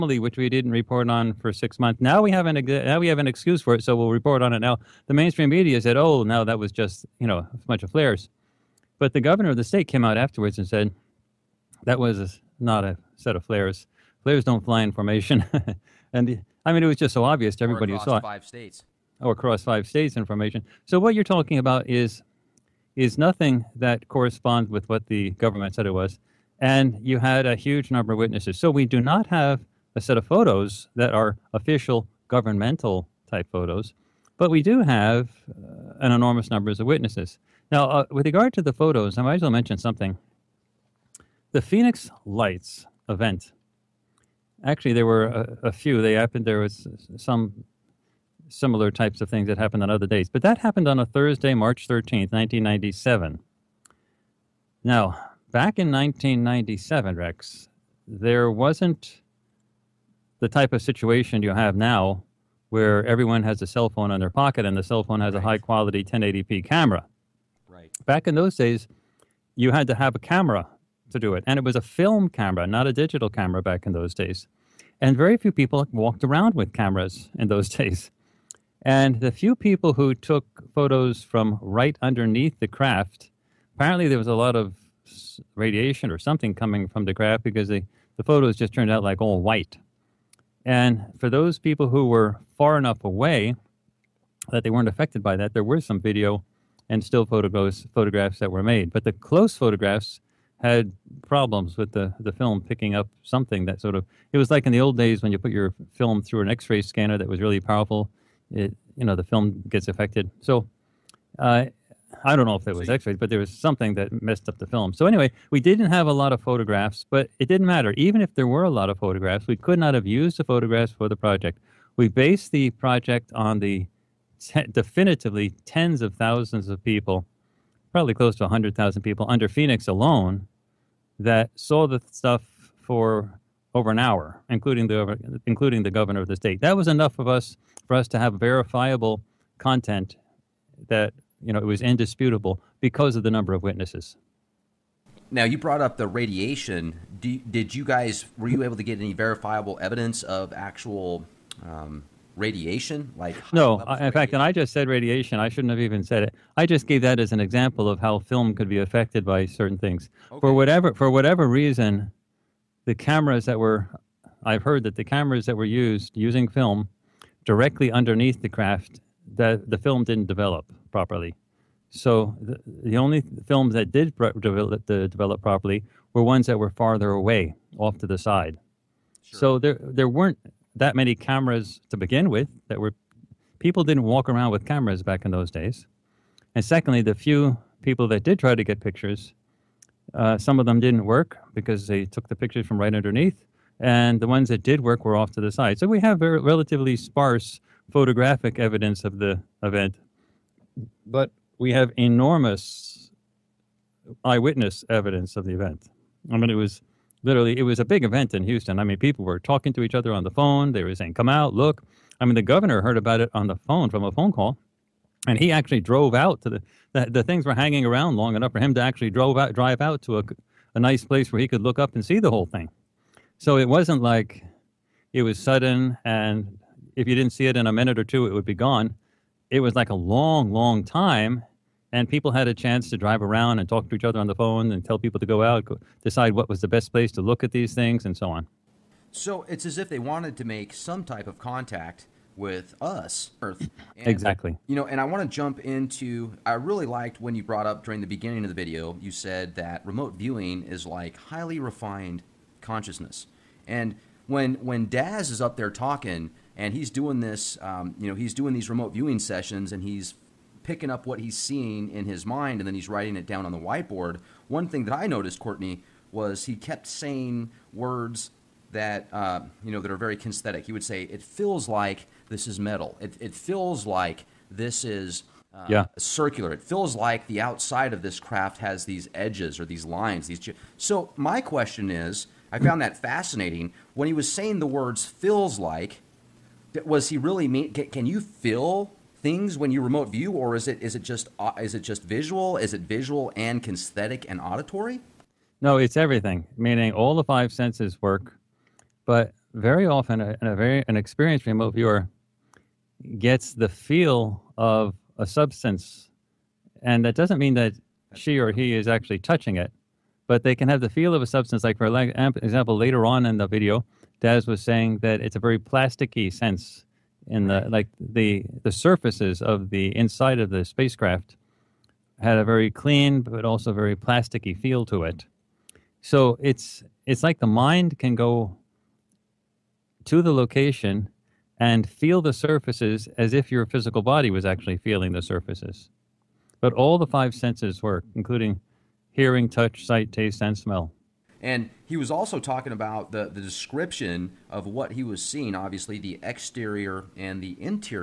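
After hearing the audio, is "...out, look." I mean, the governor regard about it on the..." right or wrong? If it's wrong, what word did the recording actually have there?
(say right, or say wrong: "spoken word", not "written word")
wrong: "heard", not "regard".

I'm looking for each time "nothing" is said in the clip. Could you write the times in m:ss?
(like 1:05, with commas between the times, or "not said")
0:23.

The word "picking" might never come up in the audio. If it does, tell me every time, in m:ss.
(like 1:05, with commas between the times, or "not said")
1:42, 4:20.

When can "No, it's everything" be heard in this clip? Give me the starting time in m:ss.
4:55.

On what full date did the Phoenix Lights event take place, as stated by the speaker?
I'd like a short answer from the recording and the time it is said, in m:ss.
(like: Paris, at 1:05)
March 13th, 1997, at 0:51.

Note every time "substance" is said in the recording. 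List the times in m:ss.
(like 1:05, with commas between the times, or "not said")
5:05, 5:11.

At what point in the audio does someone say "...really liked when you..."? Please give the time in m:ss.
4:06.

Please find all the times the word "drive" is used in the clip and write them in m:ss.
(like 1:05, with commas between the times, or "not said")
3:39, 3:52.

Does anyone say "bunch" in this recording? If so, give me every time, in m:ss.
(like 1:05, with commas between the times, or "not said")
0:07.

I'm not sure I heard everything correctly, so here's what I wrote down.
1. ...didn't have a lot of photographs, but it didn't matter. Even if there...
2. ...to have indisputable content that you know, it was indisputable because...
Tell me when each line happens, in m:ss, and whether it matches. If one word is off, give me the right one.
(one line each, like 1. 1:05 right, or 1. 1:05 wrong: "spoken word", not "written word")
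1. 1:55 right
2. 2:18 wrong: "verifiable", not "indisputable".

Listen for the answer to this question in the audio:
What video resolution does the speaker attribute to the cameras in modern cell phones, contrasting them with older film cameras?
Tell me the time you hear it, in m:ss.
1:06.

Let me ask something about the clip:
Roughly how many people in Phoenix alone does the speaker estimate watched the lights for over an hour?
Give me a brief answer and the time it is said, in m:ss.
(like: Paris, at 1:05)
100,000, at 2:08.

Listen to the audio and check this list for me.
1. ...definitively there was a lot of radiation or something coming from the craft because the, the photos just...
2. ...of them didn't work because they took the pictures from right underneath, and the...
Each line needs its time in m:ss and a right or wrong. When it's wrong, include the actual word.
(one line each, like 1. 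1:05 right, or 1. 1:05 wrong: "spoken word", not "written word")
1. 1:23 wrong: "apparently", not "definitively"
2. 3:10 right.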